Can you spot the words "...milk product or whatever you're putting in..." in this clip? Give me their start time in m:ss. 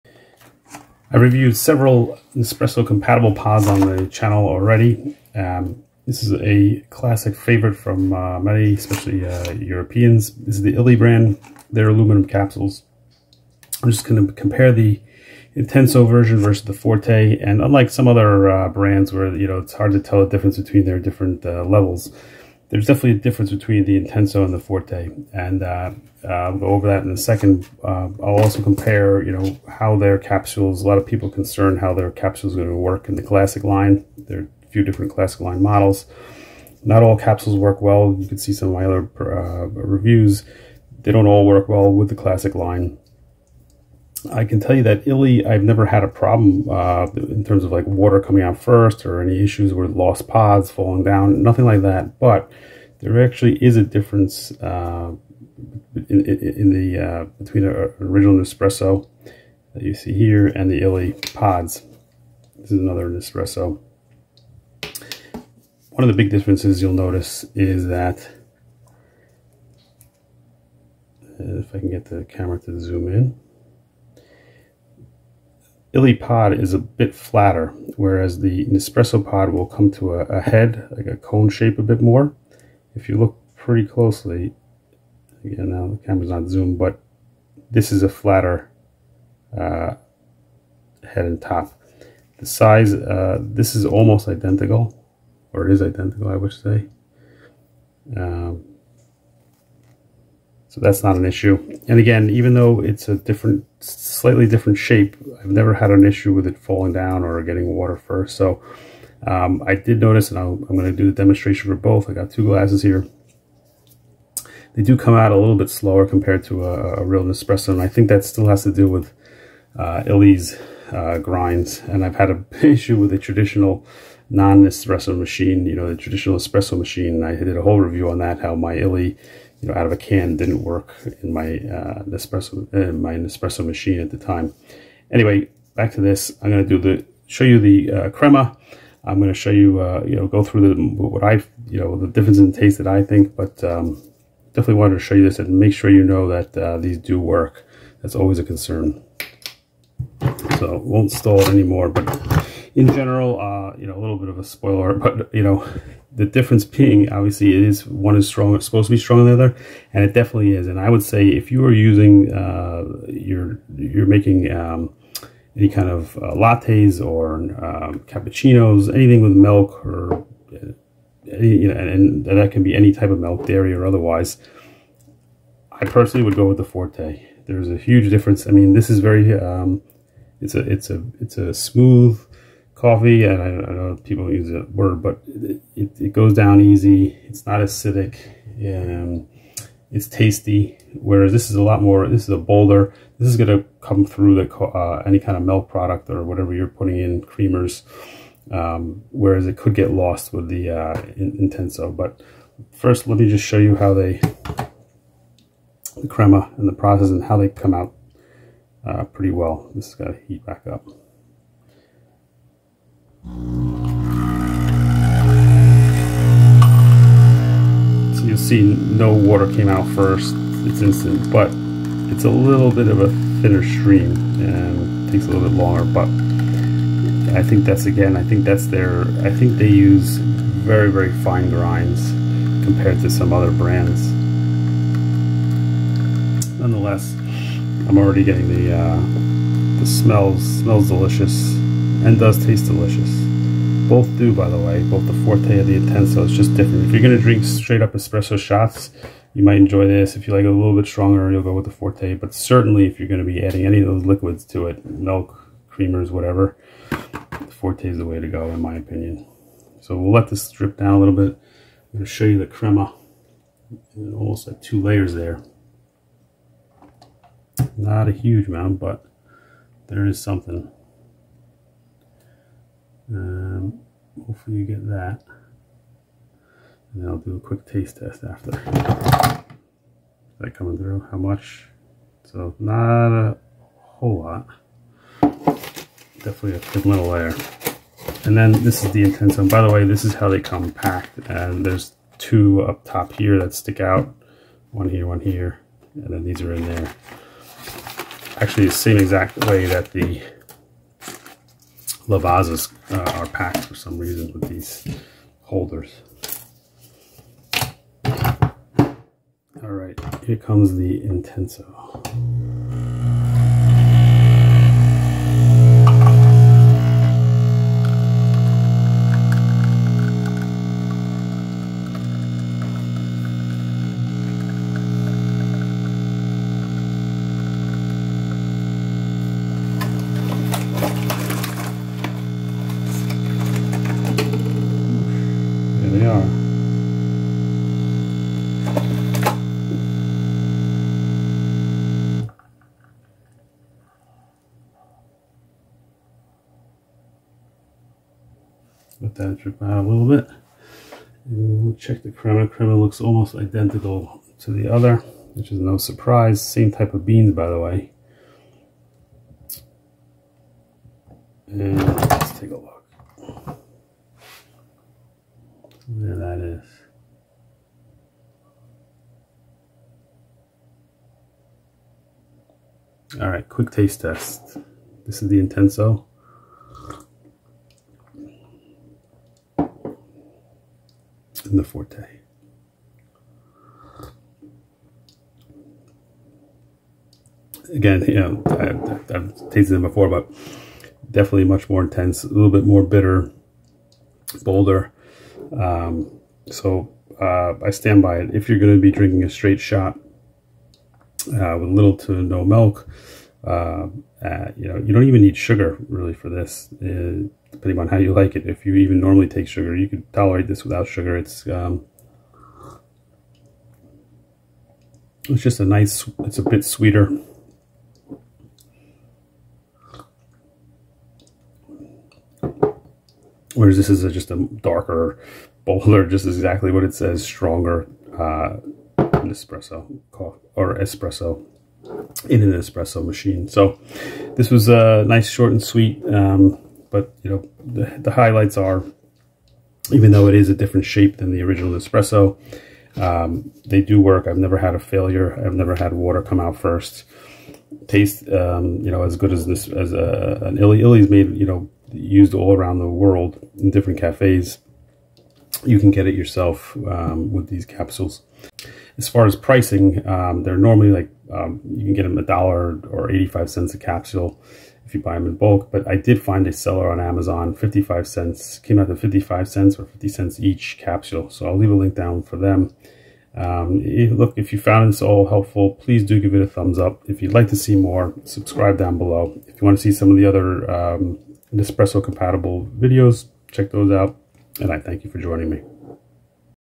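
3:15.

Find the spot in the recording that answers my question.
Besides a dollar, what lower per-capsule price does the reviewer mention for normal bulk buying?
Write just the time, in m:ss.
7:43.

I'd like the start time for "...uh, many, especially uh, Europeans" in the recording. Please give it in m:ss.
0:08.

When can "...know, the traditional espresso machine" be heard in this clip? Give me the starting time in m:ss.
2:05.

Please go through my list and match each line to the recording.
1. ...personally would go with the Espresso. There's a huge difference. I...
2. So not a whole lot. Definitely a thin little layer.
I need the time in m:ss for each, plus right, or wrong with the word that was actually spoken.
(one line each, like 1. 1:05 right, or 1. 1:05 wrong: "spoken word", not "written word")
1. 2:55 wrong: "Forte", not "Espresso"
2. 4:42 right.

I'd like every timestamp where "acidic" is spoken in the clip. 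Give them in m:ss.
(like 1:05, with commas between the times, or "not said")
3:07.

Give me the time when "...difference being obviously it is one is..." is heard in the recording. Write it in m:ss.
2:36.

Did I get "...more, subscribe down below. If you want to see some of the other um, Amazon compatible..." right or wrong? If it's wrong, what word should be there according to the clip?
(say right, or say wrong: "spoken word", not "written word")
wrong: "Espresso", not "Amazon".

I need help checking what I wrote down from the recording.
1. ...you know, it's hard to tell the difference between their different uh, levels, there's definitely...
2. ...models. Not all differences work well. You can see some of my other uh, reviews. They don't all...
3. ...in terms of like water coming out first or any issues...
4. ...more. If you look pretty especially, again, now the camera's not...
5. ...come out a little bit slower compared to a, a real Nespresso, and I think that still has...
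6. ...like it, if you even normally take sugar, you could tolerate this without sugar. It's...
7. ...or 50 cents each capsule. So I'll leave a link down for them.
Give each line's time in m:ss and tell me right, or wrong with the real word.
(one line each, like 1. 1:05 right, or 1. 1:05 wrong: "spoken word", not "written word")
1. 0:19 right
2. 0:35 wrong: "capsules", not "differences"
3. 0:47 right
4. 1:22 wrong: "closely", not "especially"
5. 1:54 right
6. 6:48 right
7. 7:49 right.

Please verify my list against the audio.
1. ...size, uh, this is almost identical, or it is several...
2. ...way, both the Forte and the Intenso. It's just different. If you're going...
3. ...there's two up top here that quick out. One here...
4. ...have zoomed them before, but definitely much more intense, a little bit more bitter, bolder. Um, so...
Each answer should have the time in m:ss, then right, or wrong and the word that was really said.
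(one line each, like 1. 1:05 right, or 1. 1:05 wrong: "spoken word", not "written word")
1. 1:32 wrong: "identical", not "several"
2. 4:04 right
3. 4:51 wrong: "stick", not "quick"
4. 6:28 wrong: "tasted", not "zoomed".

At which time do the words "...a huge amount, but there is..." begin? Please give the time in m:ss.
4:28.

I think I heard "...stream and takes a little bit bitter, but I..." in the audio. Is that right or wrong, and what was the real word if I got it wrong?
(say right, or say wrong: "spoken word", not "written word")
wrong: "longer", not "bitter".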